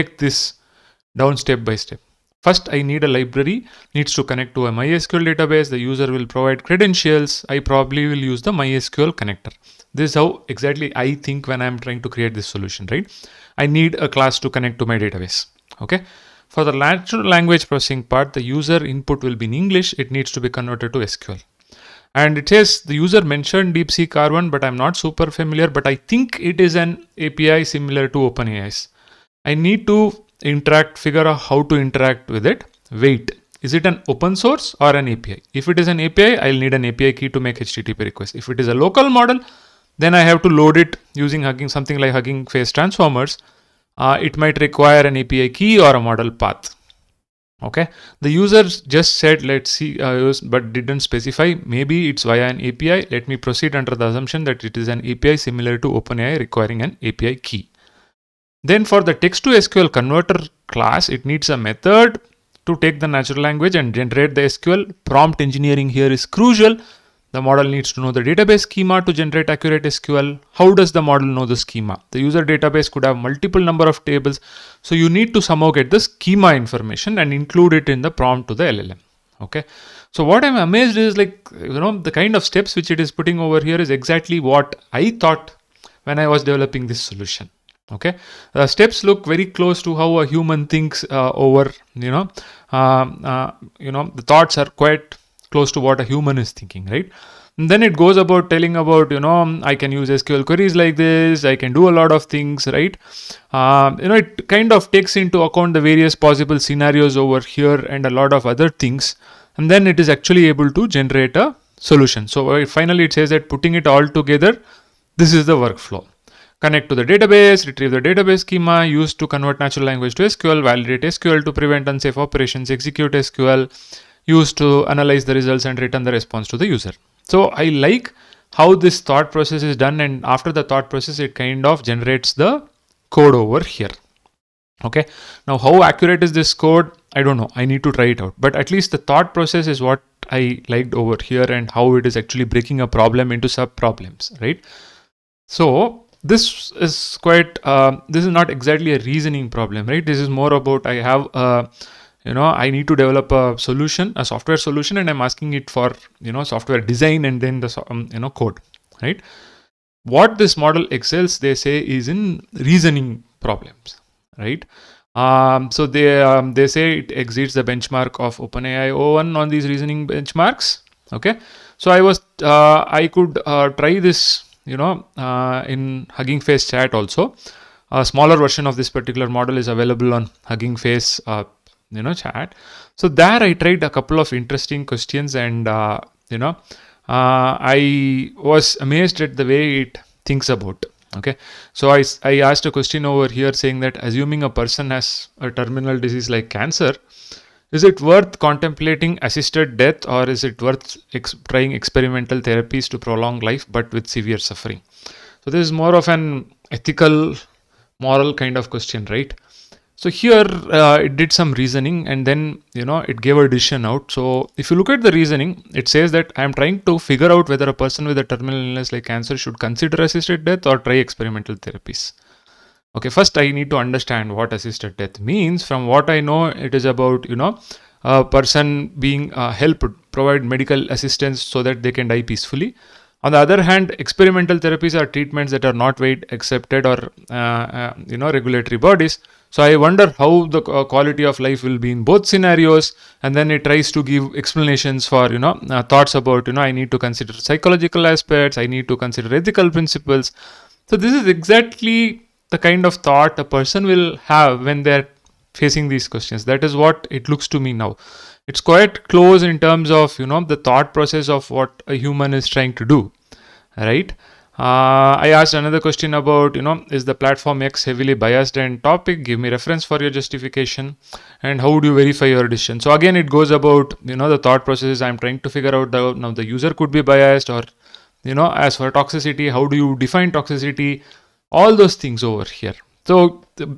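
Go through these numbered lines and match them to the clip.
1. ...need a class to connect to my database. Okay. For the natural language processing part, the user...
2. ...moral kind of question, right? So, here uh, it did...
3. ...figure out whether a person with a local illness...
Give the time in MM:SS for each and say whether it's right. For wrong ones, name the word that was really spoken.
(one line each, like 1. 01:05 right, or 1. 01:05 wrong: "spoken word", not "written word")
1. 00:13 right
2. 03:28 right
3. 03:36 wrong: "terminal", not "local".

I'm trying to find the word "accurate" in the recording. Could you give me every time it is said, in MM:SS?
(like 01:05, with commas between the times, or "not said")
01:09, 02:15.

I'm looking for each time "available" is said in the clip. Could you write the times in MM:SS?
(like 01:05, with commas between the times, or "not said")
02:59.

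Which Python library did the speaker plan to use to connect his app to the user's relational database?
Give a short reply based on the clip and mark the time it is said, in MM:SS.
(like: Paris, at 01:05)
MySQL connector, at 00:08.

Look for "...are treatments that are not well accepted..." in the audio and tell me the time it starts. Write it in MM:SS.
03:54.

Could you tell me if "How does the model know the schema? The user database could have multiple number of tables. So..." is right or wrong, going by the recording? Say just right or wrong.
right.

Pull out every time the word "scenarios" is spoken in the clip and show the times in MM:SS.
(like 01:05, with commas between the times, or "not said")
01:46, 04:02.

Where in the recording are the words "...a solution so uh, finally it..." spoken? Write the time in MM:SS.
01:51.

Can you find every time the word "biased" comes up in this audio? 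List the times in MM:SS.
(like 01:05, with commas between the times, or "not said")
04:28, 04:37.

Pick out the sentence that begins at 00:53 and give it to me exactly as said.
Let me proceed under the assumption that it is an API similar to OpenAI requiring an API key.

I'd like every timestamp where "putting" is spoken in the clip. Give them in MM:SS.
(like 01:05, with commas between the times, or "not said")
01:23, 01:53.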